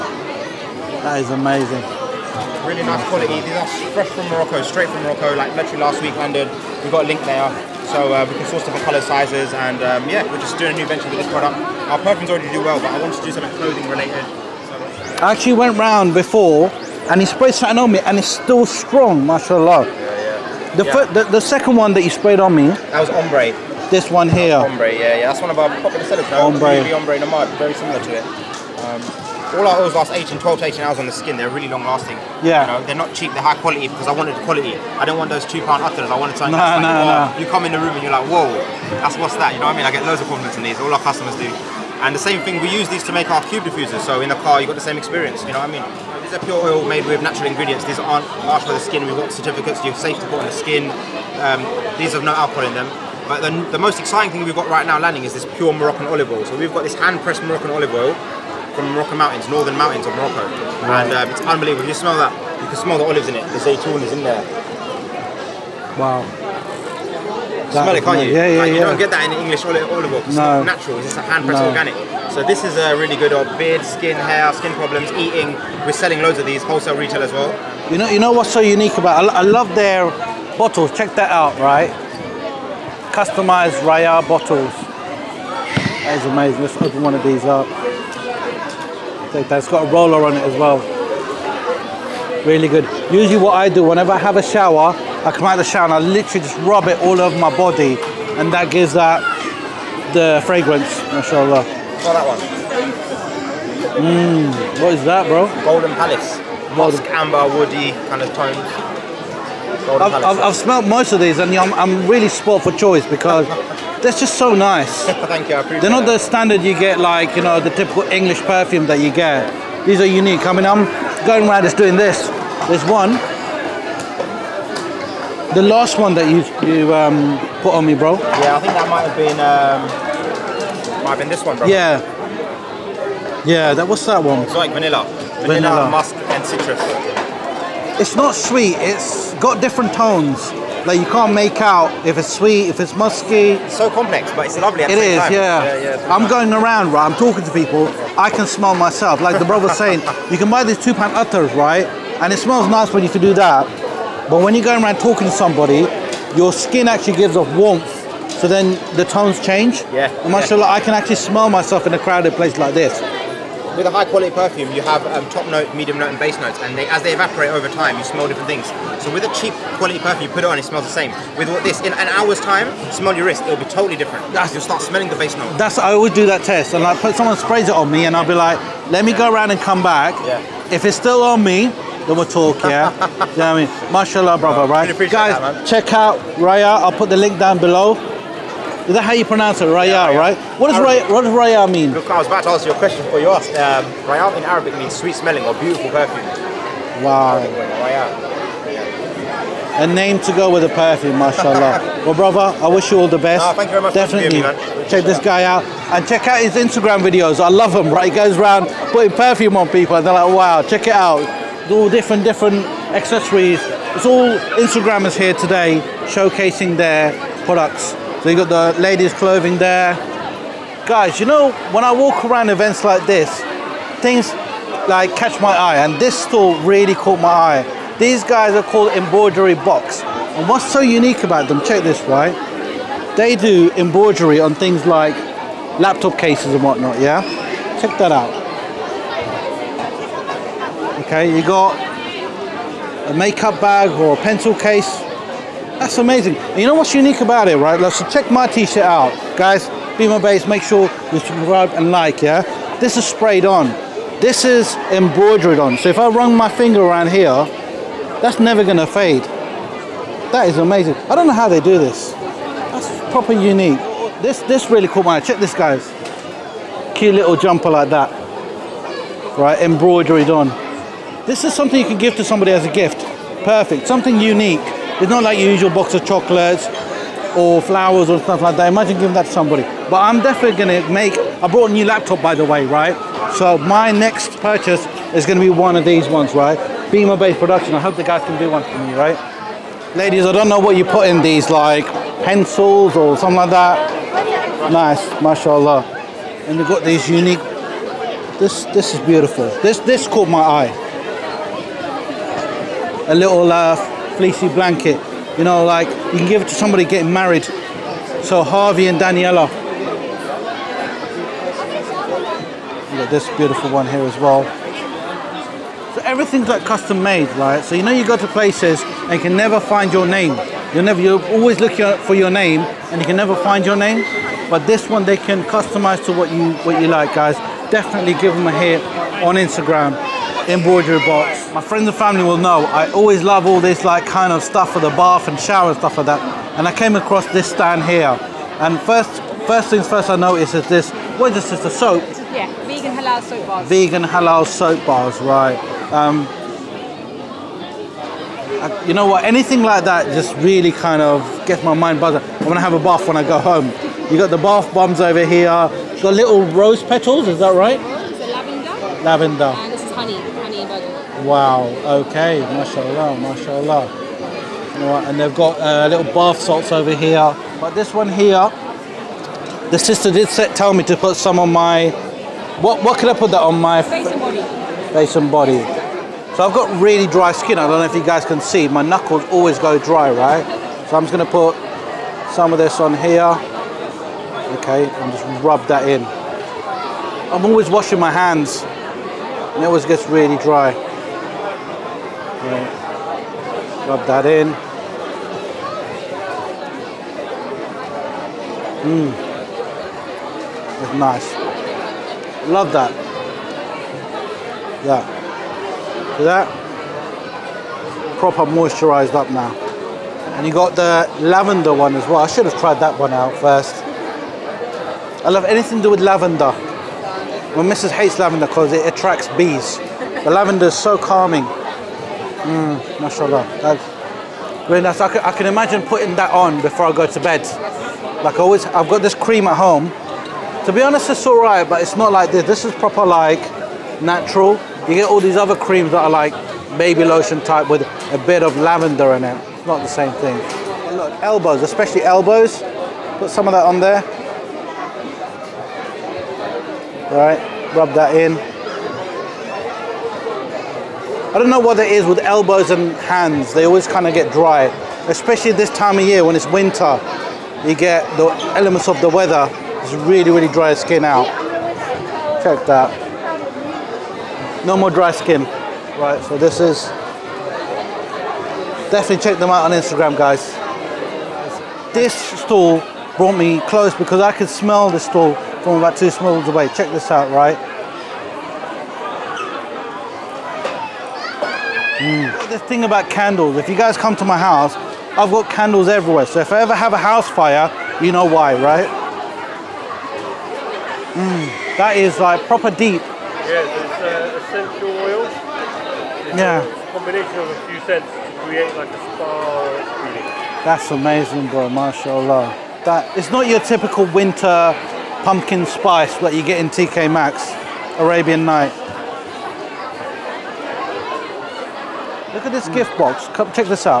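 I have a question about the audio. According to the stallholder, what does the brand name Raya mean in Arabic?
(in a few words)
sweet smelling.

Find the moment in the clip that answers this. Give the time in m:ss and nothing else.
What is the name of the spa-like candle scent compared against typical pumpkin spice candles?
8:28.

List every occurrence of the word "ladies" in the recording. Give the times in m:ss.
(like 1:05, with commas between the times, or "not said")
3:38, 4:49.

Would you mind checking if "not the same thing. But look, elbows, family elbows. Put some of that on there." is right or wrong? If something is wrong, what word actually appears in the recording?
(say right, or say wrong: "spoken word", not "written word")
wrong: "especially", not "family".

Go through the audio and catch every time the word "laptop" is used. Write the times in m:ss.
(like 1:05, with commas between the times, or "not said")
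3:55, 4:41.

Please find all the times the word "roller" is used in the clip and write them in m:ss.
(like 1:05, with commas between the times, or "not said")
1:29.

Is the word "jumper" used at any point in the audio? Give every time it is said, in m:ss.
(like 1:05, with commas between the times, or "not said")
4:27.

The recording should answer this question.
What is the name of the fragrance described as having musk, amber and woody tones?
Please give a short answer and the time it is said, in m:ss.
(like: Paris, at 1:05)
Golden Palace, at 1:45.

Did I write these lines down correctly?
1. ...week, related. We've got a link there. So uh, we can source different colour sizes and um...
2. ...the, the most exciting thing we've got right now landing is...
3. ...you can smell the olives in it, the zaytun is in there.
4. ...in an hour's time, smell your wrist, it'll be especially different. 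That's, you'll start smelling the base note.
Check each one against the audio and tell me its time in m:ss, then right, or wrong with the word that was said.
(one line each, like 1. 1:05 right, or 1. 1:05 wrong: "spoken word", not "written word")
1. 0:06 wrong: "landed", not "related"
2. 0:53 right
3. 1:02 right
4. 2:51 wrong: "totally", not "especially".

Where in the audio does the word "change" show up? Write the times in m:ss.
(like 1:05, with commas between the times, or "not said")
2:39.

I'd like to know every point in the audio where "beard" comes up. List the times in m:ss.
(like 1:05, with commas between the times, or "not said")
1:13.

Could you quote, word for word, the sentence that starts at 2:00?
I mean, I'm going around just doing this.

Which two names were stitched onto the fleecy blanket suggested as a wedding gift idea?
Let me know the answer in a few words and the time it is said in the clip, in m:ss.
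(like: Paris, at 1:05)
Harvey and Daniela, at 5:08.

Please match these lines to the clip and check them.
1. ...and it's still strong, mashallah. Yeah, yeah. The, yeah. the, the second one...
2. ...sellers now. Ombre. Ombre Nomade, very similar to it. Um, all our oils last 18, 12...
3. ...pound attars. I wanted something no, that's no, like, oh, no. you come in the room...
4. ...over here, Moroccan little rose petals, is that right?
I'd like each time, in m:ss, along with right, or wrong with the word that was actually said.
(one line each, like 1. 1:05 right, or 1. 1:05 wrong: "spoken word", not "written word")
1. 0:17 right
2. 0:26 right
3. 0:35 right
4. 5:55 wrong: "The", not "Moroccan".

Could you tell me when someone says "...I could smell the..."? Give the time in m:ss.
7:54.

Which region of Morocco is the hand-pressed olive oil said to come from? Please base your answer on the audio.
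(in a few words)
northern mountains.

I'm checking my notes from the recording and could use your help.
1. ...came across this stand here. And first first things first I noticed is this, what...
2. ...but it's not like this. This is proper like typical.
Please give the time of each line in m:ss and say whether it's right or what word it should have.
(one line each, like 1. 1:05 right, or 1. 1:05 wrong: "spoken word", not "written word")
1. 5:36 right
2. 7:11 wrong: "natural", not "typical".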